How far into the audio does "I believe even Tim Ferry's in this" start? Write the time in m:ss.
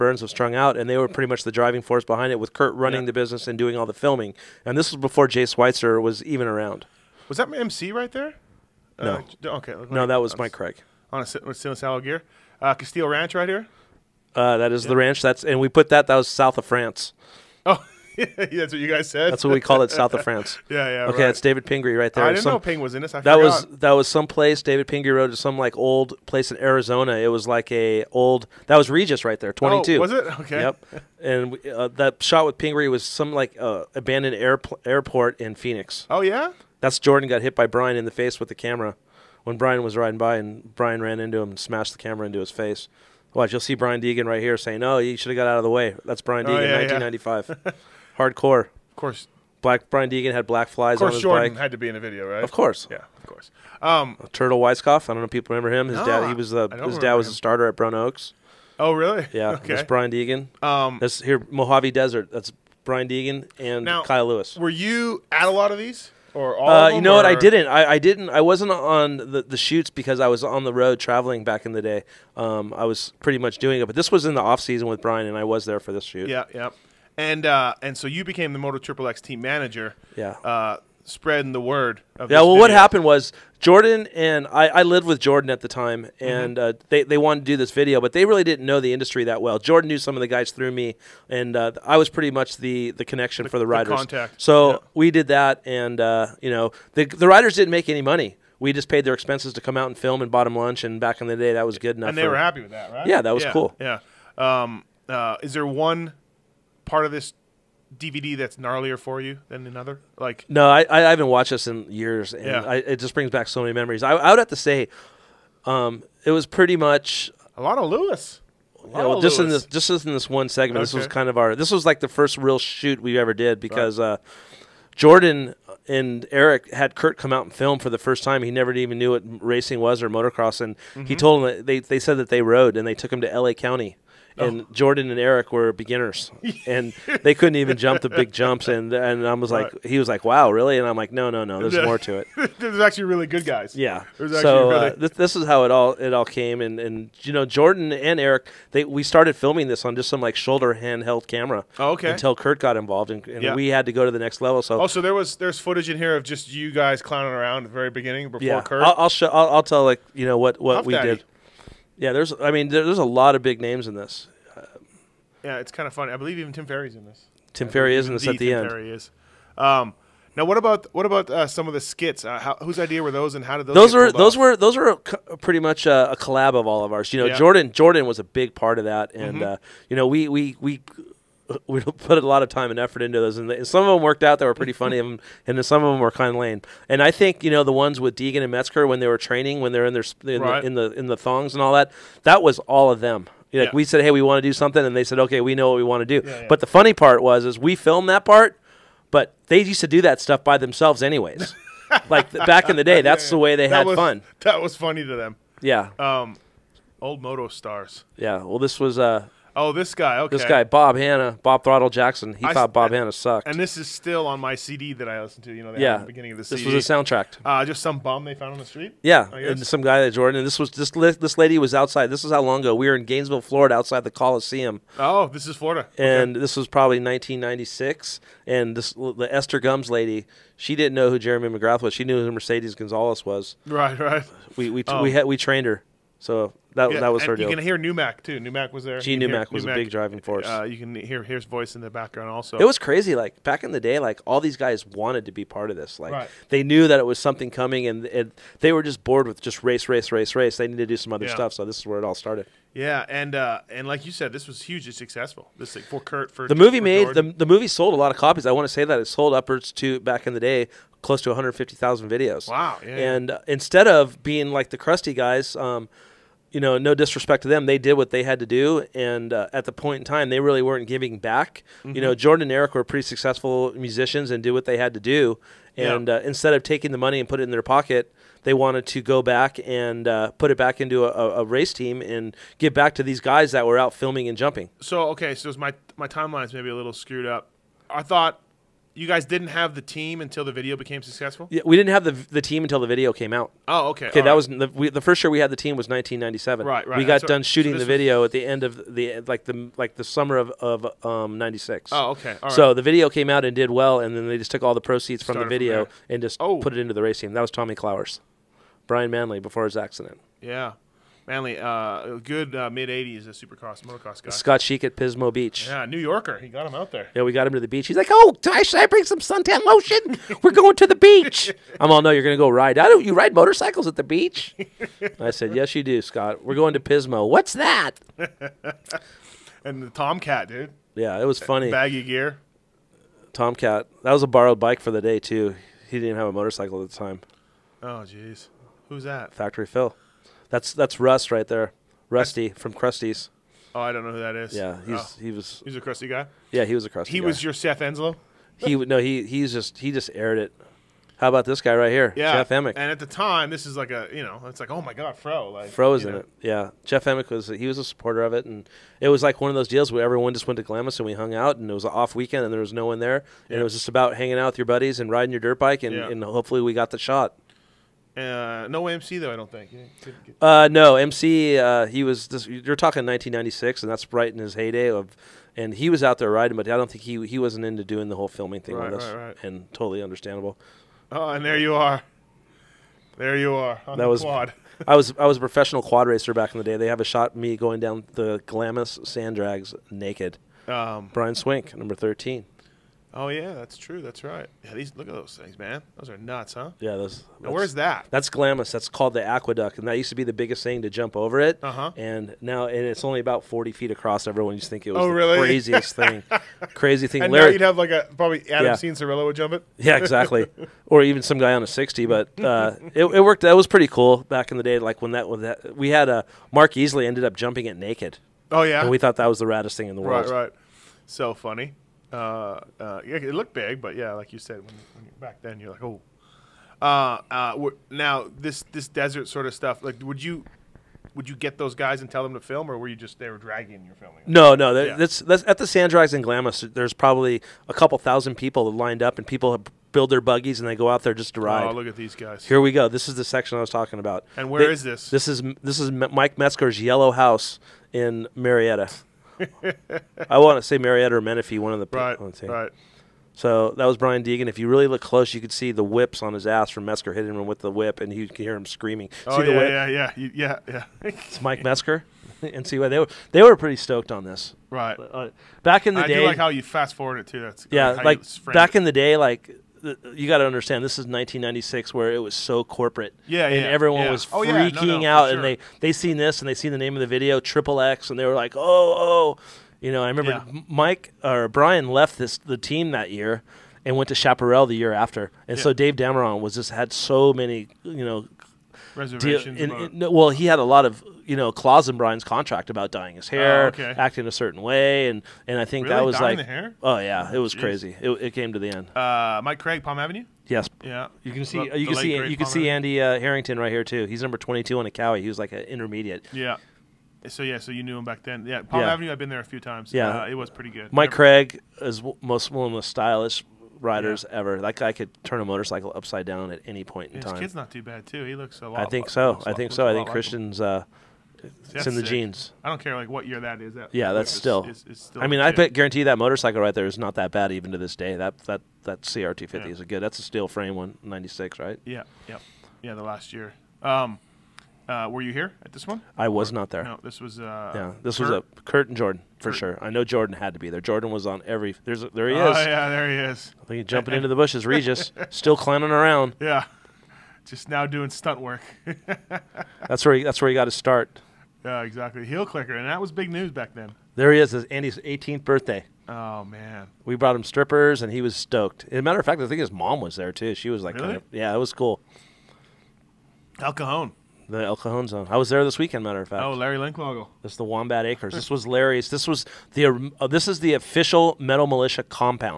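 2:46.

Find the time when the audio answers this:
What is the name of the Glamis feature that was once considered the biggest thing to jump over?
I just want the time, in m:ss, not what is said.
6:39.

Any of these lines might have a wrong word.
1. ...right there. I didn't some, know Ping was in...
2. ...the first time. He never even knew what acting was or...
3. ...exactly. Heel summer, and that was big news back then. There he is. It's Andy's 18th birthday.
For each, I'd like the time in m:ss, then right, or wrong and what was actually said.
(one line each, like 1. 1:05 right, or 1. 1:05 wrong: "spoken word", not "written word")
1. 0:21 right
2. 2:07 wrong: "racing", not "acting"
3. 9:11 wrong: "clicker", not "summer".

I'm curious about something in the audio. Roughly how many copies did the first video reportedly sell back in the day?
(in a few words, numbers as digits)
150,000.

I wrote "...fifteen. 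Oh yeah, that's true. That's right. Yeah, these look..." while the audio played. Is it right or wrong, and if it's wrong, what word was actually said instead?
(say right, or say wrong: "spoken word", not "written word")
wrong: "thirteen", not "fifteen".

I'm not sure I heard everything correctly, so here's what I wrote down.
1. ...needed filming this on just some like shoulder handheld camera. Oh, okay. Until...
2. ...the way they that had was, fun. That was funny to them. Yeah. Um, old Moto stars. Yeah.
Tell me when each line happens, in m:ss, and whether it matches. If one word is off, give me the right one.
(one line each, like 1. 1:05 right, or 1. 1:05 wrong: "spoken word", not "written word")
1. 2:29 wrong: "started", not "needed"
2. 3:23 right.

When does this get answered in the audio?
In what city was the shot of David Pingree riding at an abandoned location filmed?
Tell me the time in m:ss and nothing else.
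0:35.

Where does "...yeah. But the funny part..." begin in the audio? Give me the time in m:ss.
3:16.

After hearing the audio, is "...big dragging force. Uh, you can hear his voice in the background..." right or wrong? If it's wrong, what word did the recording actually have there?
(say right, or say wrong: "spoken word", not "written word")
wrong: "driving", not "dragging".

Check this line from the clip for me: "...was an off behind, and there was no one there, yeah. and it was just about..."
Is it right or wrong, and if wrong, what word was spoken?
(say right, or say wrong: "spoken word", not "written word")
wrong: "weekend", not "behind".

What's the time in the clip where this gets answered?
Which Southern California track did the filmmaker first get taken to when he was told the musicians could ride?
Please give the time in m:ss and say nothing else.
2:13.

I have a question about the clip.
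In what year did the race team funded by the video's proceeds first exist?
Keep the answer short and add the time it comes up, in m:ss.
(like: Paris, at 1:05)
1997, at 4:55.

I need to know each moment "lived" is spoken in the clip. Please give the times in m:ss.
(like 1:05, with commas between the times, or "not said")
1:24.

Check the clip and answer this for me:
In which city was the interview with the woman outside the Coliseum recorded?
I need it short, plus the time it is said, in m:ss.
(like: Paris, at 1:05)
Gainesville, Florida, at 3:43.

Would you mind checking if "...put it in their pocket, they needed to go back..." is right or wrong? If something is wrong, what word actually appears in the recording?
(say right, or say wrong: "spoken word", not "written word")
wrong: "wanted", not "needed".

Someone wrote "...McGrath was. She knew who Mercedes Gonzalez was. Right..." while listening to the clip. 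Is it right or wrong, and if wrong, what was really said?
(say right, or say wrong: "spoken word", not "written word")
right.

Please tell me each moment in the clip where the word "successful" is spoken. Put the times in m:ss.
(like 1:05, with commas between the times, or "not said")
4:14, 4:33, 4:51.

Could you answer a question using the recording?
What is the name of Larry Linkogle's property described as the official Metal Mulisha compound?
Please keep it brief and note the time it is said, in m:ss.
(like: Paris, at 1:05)
Wombat Acres, at 9:27.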